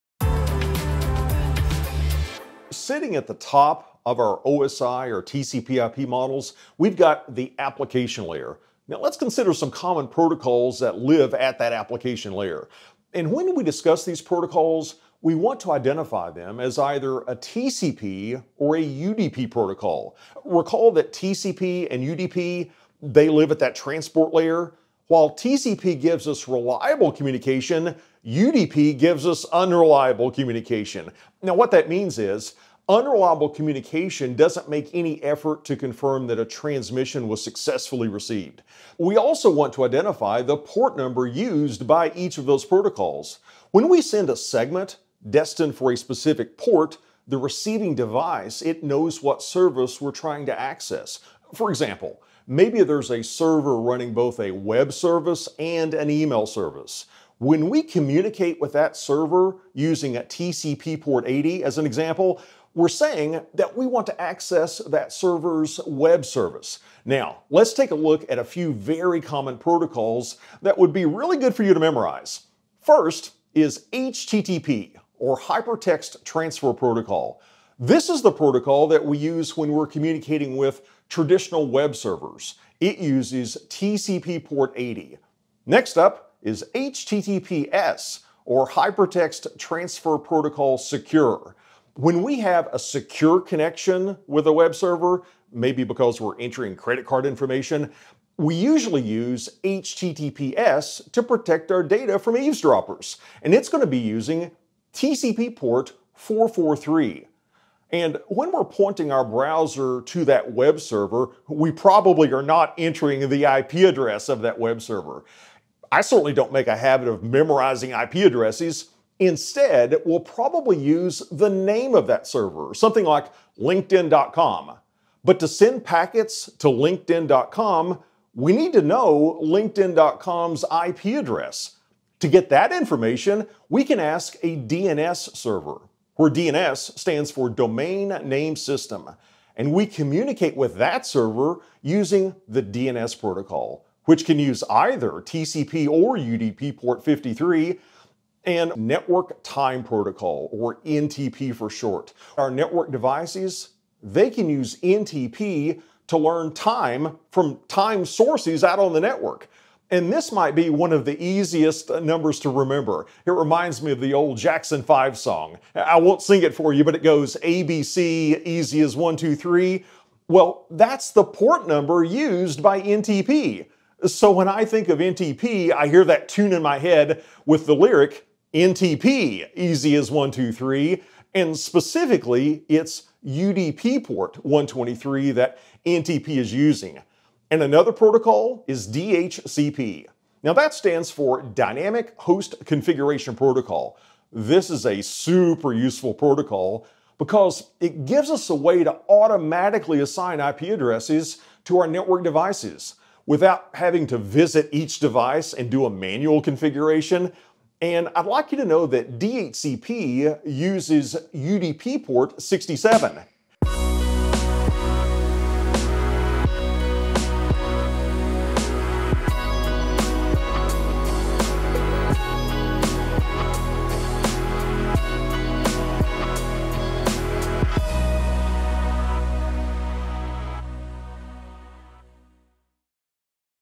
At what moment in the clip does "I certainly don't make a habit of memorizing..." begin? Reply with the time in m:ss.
1:55.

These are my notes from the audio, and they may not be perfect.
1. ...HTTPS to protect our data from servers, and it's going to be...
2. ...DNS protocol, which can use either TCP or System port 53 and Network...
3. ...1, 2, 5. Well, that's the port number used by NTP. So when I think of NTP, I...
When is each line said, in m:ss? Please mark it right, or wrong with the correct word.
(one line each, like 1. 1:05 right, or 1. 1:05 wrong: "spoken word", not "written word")
1. 1:39 wrong: "eavesdroppers", not "servers"
2. 2:22 wrong: "UDP", not "System"
3. 2:48 wrong: "3", not "5".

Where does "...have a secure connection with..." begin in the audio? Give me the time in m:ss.
1:32.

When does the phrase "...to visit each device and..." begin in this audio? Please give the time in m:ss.
3:24.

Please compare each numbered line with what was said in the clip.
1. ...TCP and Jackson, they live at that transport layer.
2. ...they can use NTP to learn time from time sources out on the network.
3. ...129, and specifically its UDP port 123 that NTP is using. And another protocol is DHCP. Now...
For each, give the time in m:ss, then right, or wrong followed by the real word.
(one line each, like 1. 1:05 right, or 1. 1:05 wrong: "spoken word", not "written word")
1. 0:21 wrong: "UDP", not "Jackson"
2. 2:34 right
3. 3:00 wrong: "123", not "129".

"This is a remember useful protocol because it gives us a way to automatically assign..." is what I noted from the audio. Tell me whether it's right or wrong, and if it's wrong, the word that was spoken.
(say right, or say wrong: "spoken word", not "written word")
wrong: "super", not "remember".